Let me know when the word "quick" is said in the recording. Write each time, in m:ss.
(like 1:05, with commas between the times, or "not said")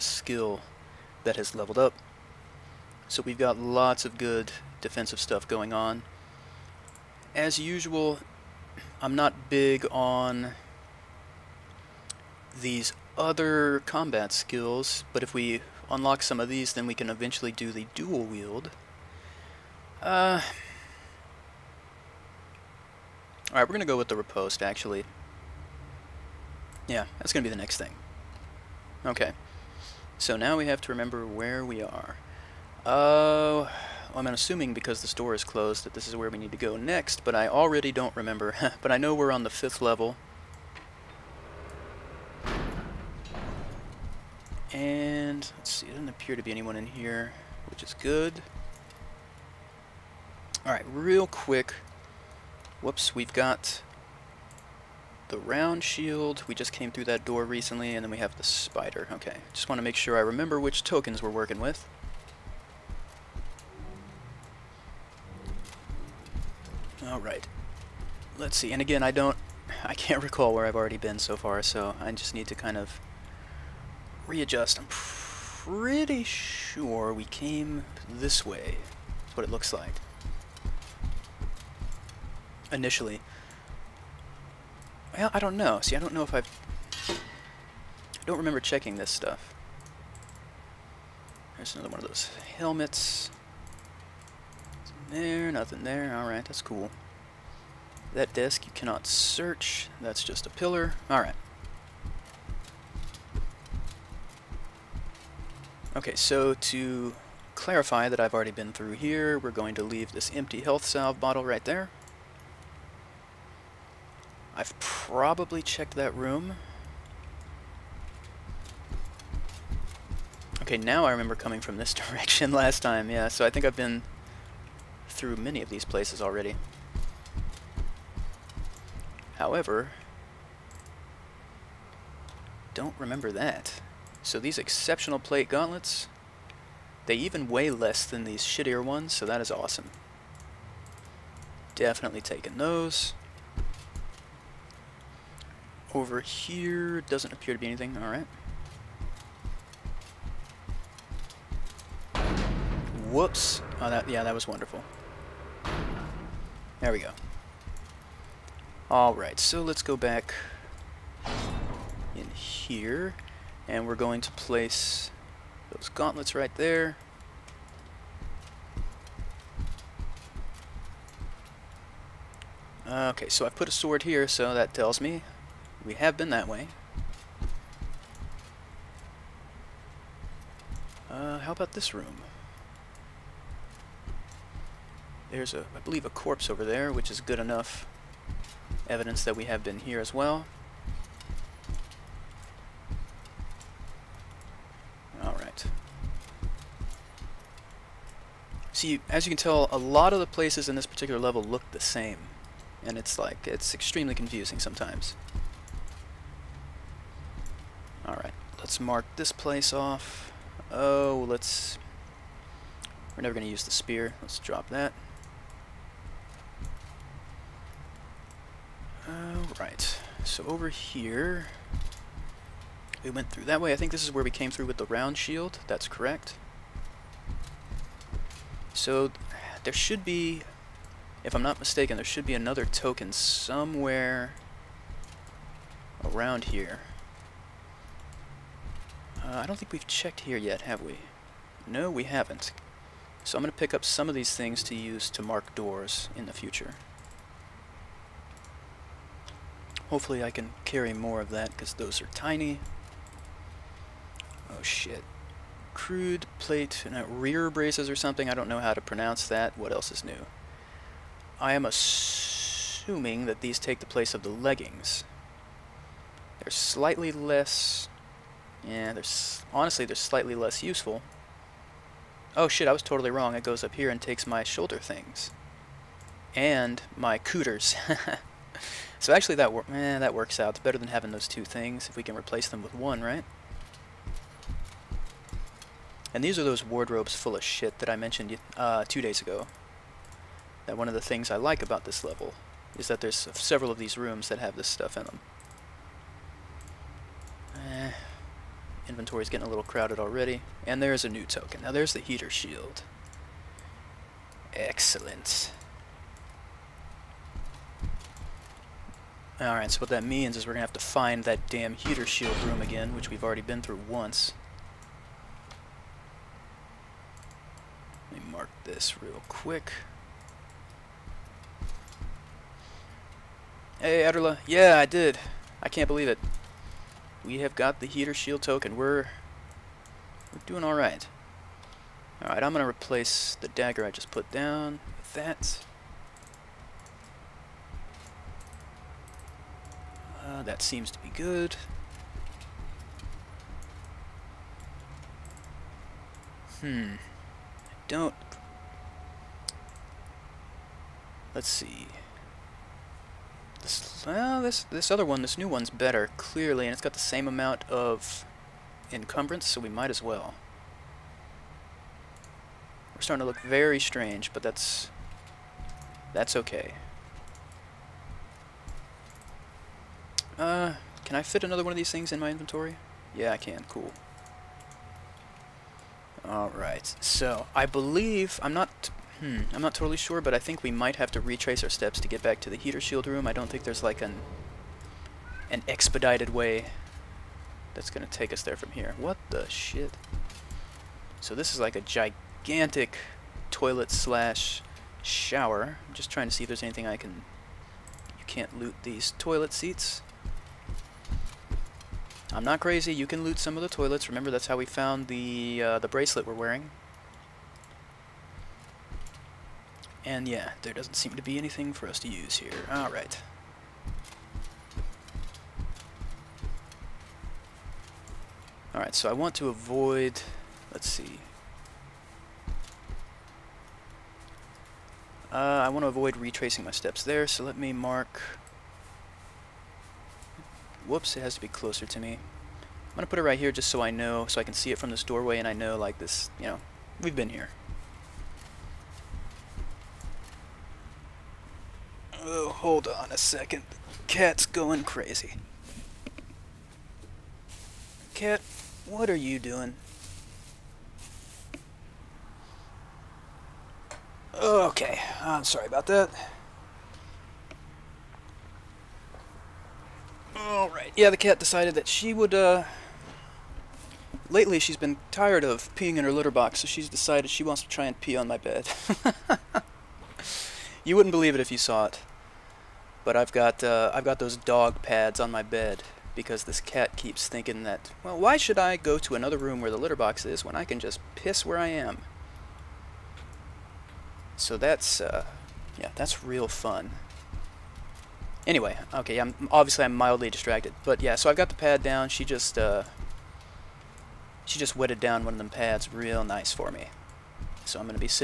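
0:51, 5:19.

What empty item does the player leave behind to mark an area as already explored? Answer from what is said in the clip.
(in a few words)
Health salve bottle.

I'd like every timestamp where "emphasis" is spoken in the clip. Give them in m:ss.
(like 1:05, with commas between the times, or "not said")
not said.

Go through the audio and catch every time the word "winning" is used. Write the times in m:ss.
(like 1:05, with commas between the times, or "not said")
not said.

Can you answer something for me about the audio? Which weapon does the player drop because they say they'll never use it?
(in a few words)
Spear.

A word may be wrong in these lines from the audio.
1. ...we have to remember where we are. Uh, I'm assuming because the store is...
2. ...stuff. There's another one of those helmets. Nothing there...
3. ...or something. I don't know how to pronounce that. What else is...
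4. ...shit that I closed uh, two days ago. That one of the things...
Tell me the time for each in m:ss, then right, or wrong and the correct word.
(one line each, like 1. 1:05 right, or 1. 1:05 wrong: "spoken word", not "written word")
1. 0:30 right
2. 1:29 right
3. 4:17 right
4. 4:47 wrong: "mentioned", not "closed".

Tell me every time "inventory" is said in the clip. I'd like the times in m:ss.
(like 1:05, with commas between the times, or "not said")
4:58, 6:12.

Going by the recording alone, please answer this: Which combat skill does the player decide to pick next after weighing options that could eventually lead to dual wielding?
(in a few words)
Riposte.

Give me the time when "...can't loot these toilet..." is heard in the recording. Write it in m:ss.
6:38.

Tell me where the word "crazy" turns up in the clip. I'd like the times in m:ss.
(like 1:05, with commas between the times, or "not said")
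6:42, 7:24.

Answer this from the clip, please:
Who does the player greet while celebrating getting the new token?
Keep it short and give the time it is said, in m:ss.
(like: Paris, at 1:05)
Adderla, at 5:24.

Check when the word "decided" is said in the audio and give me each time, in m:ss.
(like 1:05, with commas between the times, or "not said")
7:41, 7:46.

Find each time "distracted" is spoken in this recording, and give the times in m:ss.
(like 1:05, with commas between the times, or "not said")
8:10.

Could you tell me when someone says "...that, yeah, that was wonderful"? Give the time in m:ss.
2:33.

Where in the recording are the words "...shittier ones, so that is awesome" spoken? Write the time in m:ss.
2:18.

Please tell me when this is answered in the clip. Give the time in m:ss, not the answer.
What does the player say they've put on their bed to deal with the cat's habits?
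7:54.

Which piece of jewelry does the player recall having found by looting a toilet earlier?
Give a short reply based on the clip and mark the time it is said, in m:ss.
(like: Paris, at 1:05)
Bracelet, at 6:45.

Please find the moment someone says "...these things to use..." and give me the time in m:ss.
4:04.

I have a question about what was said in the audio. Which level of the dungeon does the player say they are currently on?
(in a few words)
Fifth.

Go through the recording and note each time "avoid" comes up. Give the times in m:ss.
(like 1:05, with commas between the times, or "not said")
6:59, 7:05.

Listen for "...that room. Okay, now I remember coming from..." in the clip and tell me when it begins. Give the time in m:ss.
1:55.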